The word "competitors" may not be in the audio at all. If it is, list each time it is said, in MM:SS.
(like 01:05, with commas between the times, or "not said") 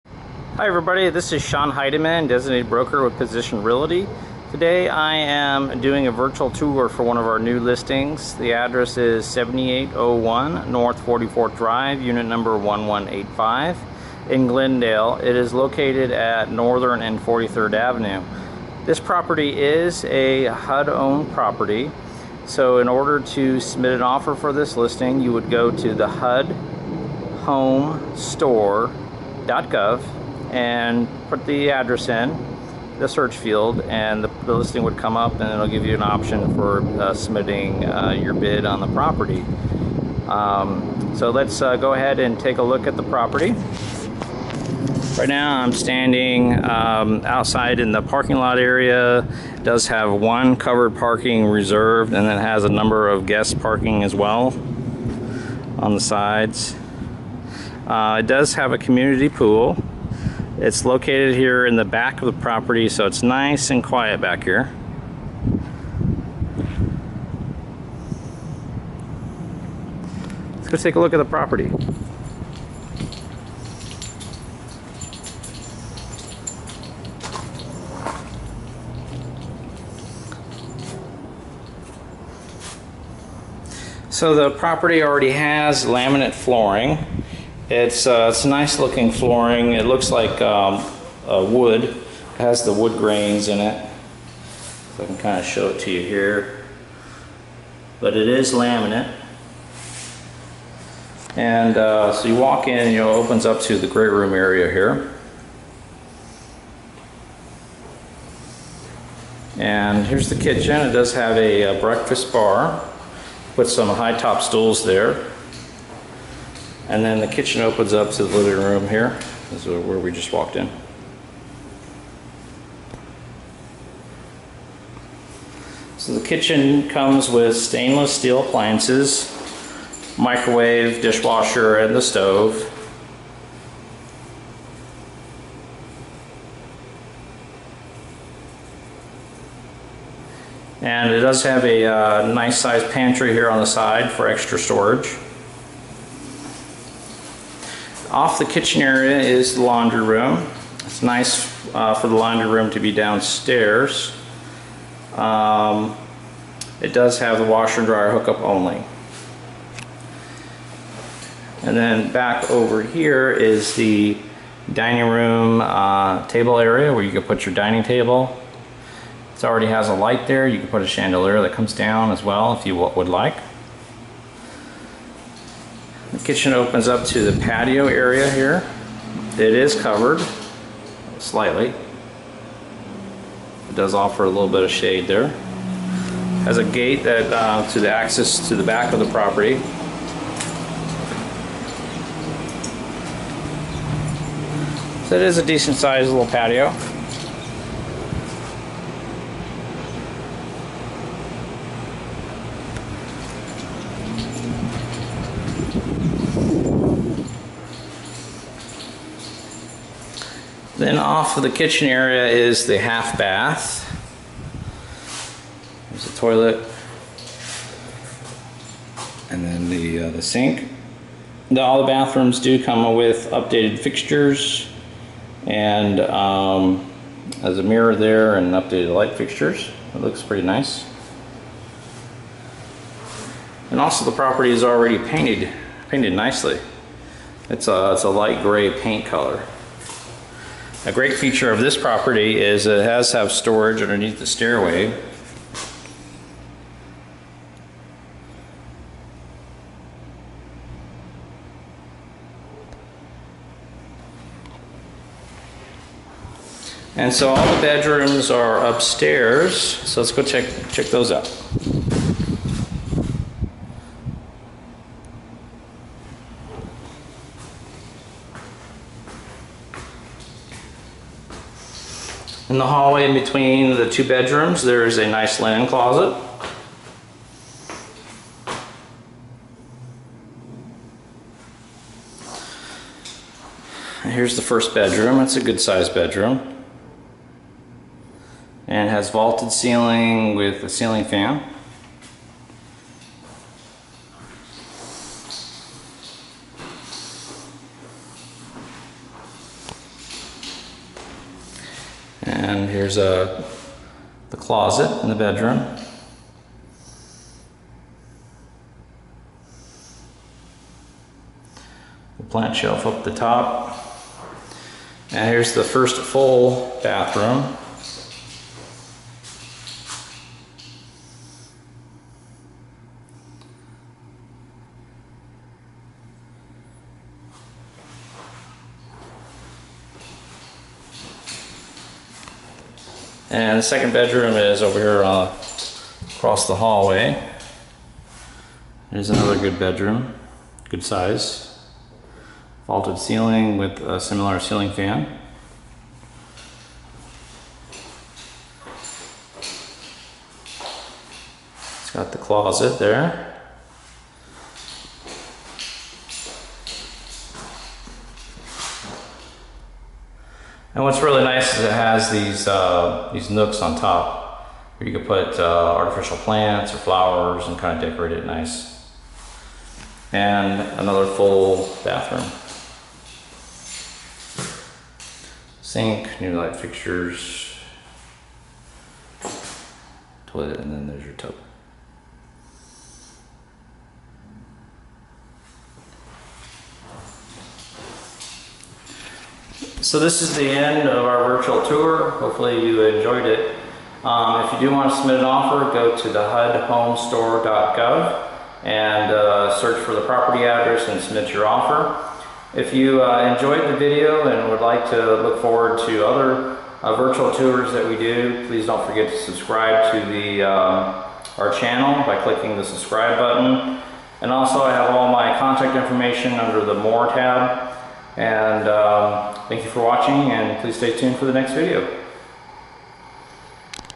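not said.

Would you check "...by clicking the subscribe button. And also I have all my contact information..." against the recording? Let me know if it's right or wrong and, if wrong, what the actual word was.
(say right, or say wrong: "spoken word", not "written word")
right.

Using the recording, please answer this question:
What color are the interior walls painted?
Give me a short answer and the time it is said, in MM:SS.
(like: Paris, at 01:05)
Light gray, at 03:58.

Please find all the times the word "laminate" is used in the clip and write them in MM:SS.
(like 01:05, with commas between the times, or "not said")
01:25, 01:38.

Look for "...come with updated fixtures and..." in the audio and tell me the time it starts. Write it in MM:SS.
03:42.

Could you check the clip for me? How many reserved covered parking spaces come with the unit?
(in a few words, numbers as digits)
1.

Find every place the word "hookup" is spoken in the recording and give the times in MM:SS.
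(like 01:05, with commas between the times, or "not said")
02:38.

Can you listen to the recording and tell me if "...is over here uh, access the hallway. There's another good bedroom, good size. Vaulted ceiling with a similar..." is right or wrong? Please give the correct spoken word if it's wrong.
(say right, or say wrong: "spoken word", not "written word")
wrong: "across", not "access".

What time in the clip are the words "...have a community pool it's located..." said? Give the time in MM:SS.
00:58.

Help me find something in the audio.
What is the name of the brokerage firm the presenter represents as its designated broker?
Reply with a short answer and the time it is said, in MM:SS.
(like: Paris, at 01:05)
Position Realty, at 00:03.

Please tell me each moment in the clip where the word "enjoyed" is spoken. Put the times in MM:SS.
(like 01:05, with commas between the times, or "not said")
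06:32, 06:43.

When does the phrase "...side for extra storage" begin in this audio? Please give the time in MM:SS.
02:23.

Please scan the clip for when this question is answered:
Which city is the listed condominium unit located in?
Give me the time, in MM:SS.
00:14.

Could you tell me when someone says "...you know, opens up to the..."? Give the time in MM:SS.
01:42.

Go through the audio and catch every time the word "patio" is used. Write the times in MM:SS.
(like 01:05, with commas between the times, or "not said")
02:57, 03:16.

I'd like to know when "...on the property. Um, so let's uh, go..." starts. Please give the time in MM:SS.
00:38.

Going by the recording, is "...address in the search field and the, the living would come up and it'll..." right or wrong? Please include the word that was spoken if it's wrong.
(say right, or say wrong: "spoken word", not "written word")
wrong: "listing", not "living".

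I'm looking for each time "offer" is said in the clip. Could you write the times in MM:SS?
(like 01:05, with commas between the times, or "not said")
00:24, 03:03, 06:35, 06:41.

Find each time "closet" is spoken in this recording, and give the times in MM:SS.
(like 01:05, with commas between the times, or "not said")
04:35, 05:04, 05:52.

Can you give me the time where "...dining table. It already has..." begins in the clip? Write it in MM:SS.
02:47.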